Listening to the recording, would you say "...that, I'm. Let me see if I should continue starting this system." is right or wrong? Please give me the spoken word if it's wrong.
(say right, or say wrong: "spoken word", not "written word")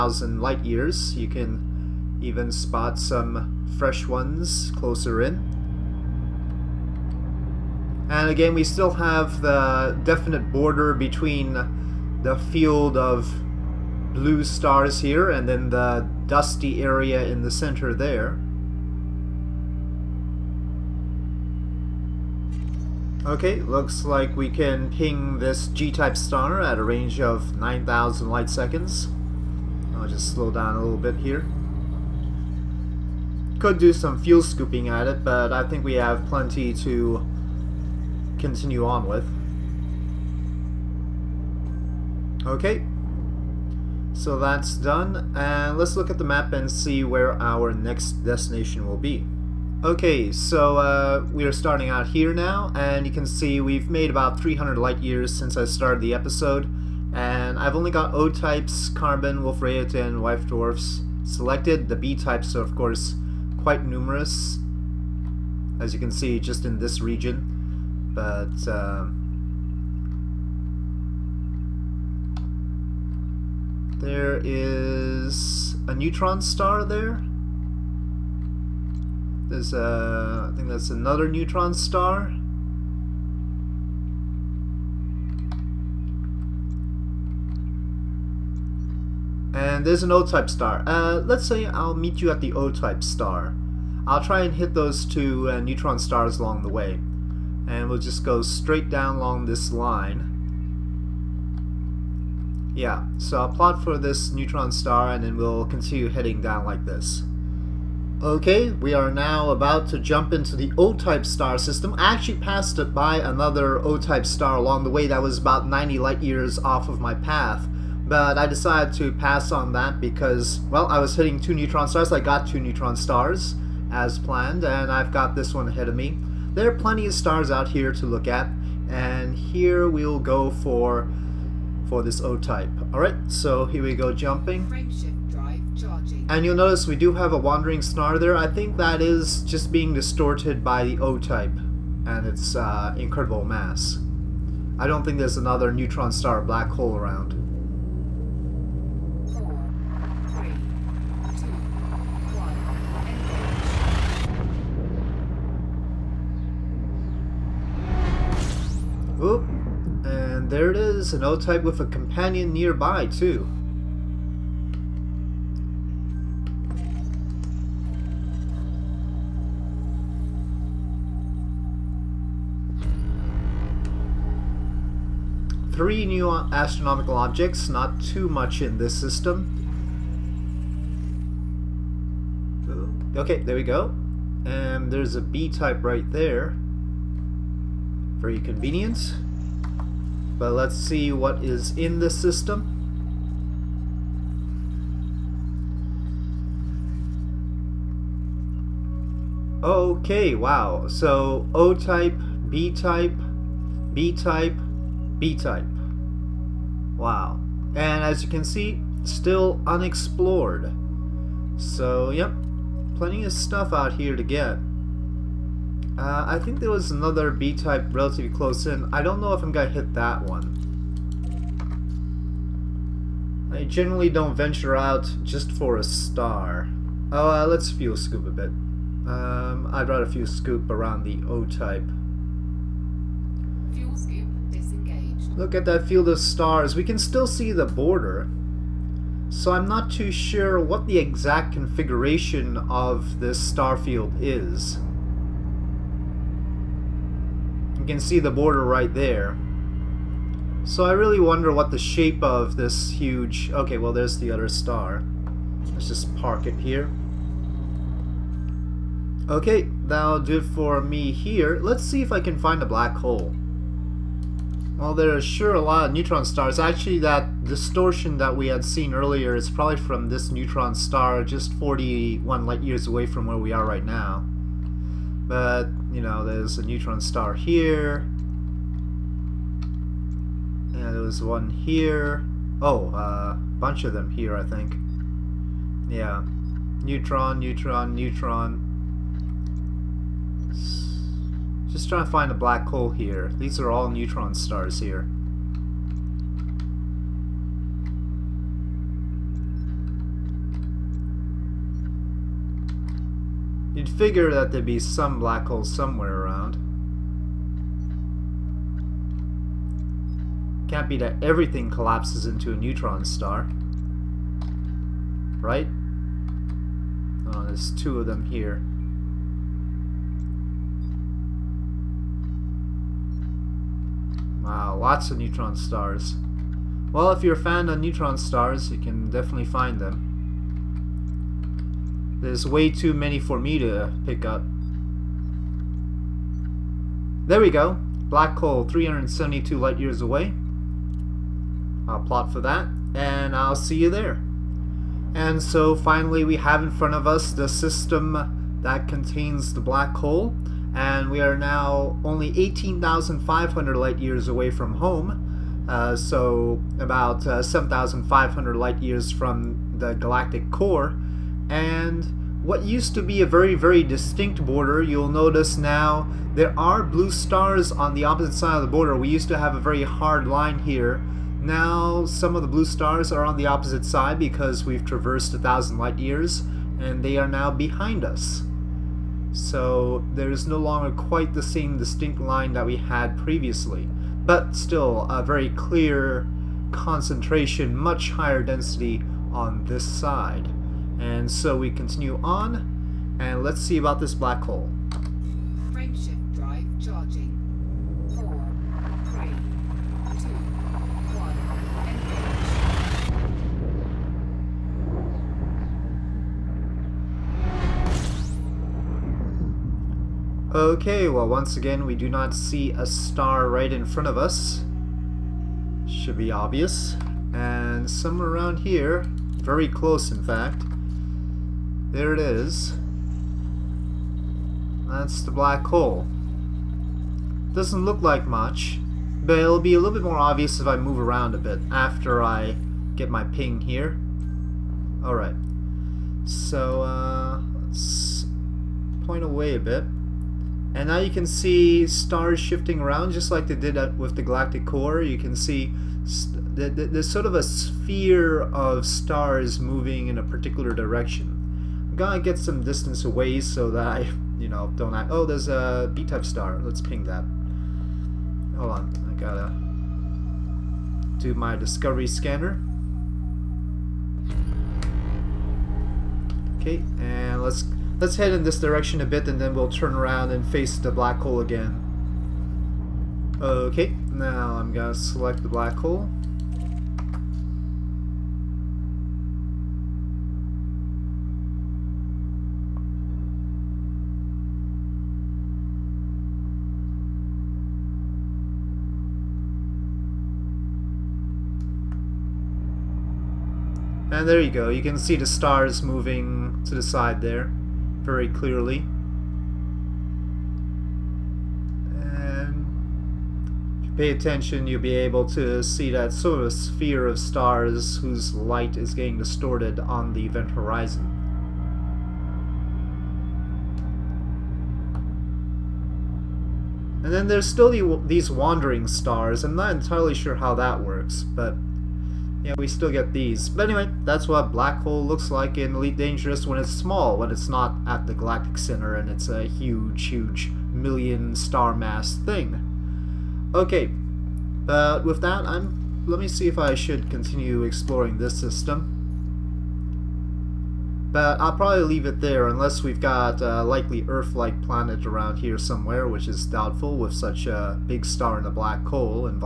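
wrong: "exploring", not "starting".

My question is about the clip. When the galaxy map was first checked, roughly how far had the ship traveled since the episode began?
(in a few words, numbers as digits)
300 light years.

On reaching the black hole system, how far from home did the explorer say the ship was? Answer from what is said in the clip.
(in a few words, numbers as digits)
18,500 light years.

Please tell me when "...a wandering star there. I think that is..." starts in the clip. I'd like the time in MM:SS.
02:17.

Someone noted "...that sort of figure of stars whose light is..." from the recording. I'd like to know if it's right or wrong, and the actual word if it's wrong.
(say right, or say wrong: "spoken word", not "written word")
wrong: "sphere", not "figure".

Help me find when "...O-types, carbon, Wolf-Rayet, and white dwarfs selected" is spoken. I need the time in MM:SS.
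00:58.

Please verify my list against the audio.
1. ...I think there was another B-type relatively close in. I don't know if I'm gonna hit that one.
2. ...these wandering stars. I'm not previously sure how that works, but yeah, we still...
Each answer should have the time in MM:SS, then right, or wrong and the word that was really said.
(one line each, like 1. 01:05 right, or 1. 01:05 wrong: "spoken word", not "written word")
1. 03:36 right
2. 08:38 wrong: "entirely", not "previously".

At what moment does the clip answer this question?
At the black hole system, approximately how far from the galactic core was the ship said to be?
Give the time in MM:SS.
05:57.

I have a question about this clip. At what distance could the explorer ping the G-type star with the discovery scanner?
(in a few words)
9,000 light seconds.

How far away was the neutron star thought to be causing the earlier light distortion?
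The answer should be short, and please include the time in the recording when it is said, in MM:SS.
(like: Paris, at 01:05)
41 light years, at 04:31.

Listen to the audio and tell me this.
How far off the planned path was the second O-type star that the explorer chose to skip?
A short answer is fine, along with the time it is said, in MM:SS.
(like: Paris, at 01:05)
90 light years, at 01:55.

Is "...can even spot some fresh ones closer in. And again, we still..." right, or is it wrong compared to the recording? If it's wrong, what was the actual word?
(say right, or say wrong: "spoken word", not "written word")
right.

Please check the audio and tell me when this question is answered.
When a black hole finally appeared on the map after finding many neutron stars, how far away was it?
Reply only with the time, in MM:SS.
05:38.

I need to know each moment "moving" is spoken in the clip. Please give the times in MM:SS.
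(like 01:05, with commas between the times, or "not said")
07:29, 08:15.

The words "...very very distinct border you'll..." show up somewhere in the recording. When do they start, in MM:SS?
06:03.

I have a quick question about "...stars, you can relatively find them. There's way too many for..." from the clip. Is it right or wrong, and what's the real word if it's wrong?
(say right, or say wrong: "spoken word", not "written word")
wrong: "definitely", not "relatively".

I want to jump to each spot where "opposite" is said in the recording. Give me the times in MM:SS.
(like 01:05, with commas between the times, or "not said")
06:08, 06:13.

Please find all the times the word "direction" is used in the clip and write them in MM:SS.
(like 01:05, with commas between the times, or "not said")
07:30, 07:48.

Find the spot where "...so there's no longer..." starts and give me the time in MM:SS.
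06:19.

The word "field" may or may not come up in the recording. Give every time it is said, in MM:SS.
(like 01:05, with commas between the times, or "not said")
00:12, 03:55, 04:03.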